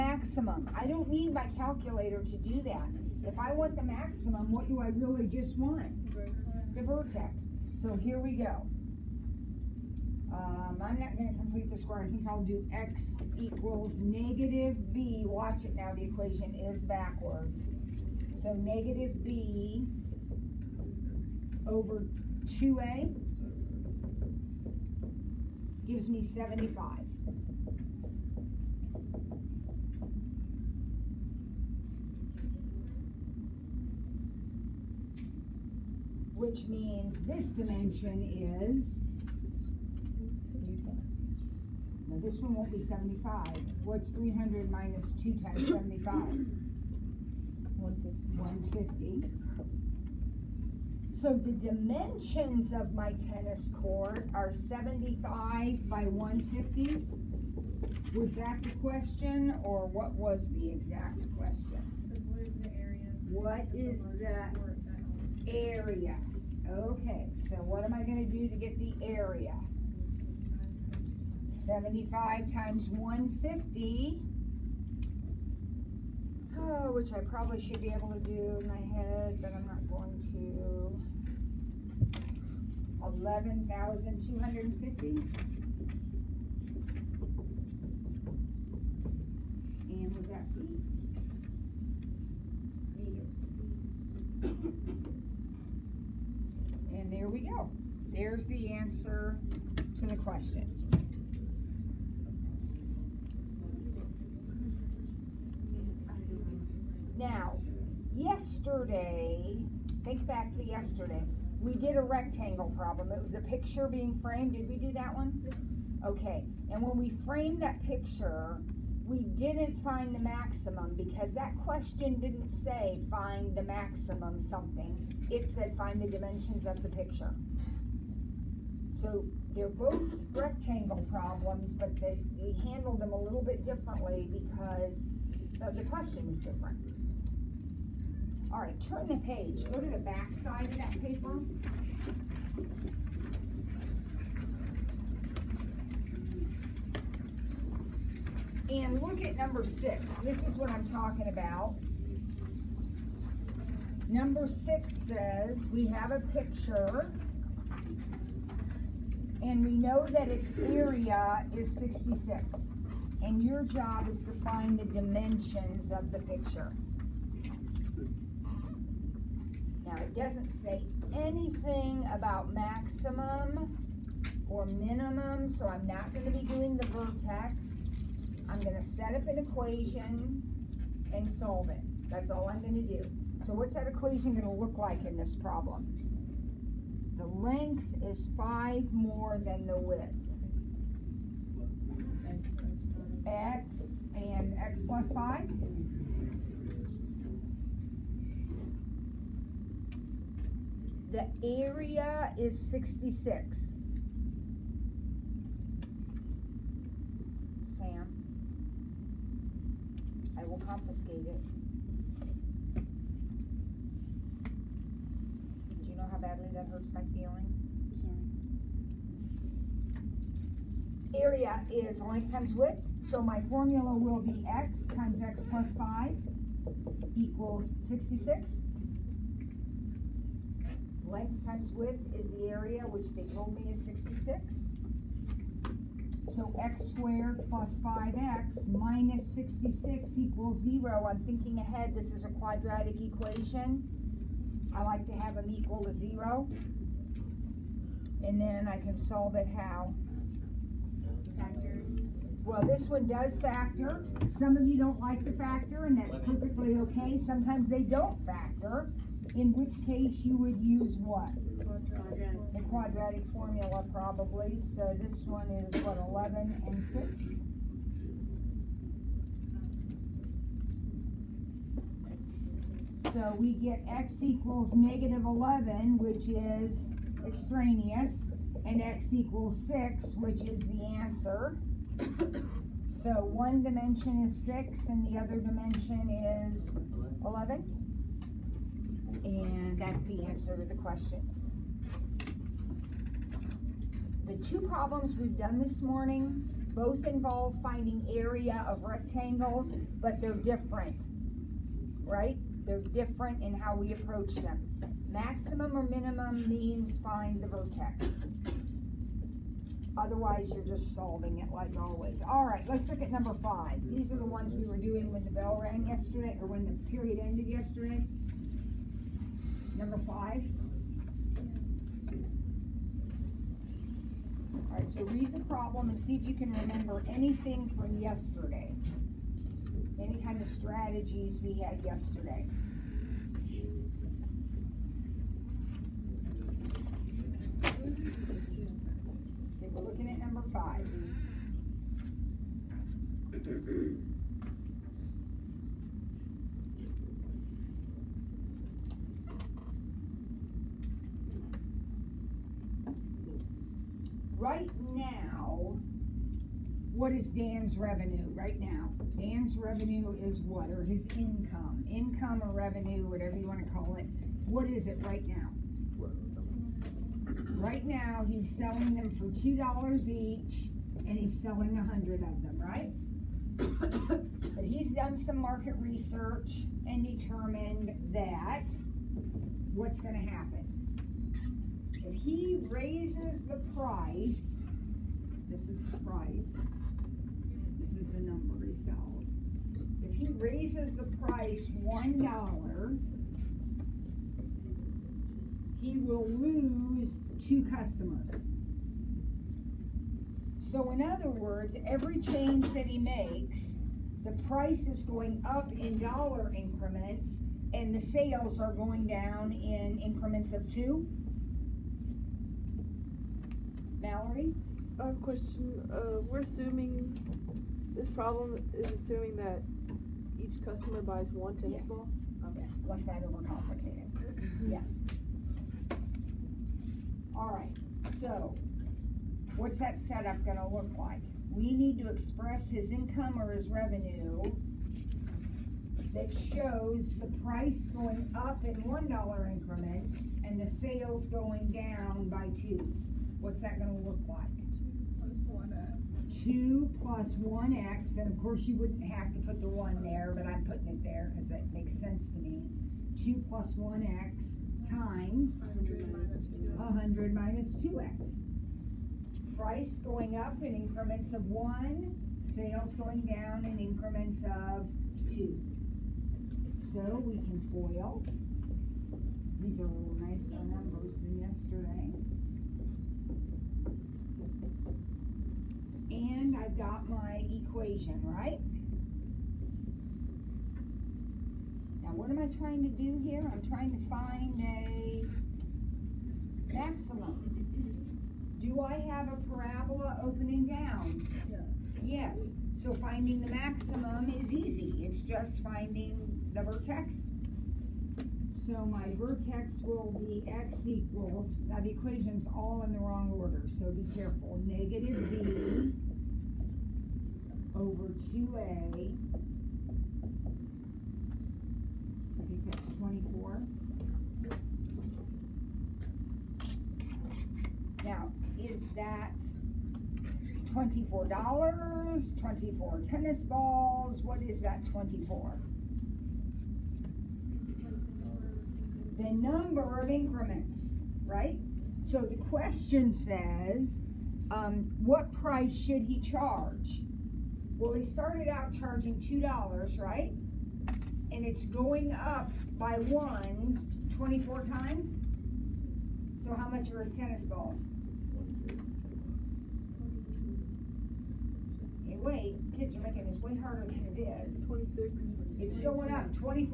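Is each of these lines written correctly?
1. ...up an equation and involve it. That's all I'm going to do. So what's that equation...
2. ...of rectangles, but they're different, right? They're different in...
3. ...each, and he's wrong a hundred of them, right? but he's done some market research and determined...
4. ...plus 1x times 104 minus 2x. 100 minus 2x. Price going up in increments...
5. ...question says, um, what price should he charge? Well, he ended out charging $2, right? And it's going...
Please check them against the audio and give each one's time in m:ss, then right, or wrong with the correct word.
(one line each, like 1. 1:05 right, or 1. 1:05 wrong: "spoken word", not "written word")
1. 2:59 wrong: "solve", not "involve"
2. 4:58 right
3. 6:10 wrong: "selling", not "wrong"
4. 7:33 wrong: "100", not "104"
5. 8:52 wrong: "started", not "ended".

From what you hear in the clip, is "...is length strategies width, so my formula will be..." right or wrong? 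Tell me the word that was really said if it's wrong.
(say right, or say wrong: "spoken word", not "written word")
wrong: "times", not "strategies".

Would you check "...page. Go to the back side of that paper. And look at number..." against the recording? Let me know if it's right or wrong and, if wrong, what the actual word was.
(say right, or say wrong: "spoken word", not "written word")
right.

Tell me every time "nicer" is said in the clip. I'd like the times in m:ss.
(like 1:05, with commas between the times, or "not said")
7:50.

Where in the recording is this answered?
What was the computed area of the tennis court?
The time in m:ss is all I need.
1:23.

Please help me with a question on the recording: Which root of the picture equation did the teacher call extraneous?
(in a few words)
-11.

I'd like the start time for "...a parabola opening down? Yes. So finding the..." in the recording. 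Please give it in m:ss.
8:09.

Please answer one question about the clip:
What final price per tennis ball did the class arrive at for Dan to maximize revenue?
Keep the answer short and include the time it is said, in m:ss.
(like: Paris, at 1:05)
26, at 9:14.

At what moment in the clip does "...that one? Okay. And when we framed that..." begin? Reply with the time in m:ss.
1:54.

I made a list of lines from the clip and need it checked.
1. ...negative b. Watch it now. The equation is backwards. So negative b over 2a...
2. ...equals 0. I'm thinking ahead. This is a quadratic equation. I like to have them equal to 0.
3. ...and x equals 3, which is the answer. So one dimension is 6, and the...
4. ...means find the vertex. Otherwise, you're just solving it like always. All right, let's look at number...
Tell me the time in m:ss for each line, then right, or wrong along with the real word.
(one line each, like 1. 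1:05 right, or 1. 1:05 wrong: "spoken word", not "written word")
1. 0:13 right
2. 4:00 right
3. 4:38 wrong: "6", not "3"
4. 5:06 right.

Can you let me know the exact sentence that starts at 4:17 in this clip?
Sometimes they don't factor in which case you would use what?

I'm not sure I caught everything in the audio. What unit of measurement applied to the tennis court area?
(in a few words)
Meters.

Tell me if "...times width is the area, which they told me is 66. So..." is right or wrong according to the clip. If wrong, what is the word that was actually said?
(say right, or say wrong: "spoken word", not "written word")
right.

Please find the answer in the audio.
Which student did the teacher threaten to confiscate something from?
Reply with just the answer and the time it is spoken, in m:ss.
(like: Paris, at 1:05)
Sam, at 3:27.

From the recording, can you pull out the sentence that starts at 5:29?
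Any kind of strategies we had yesterday.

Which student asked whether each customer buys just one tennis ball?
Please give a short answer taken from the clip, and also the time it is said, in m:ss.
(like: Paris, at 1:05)
Mallory, at 6:53.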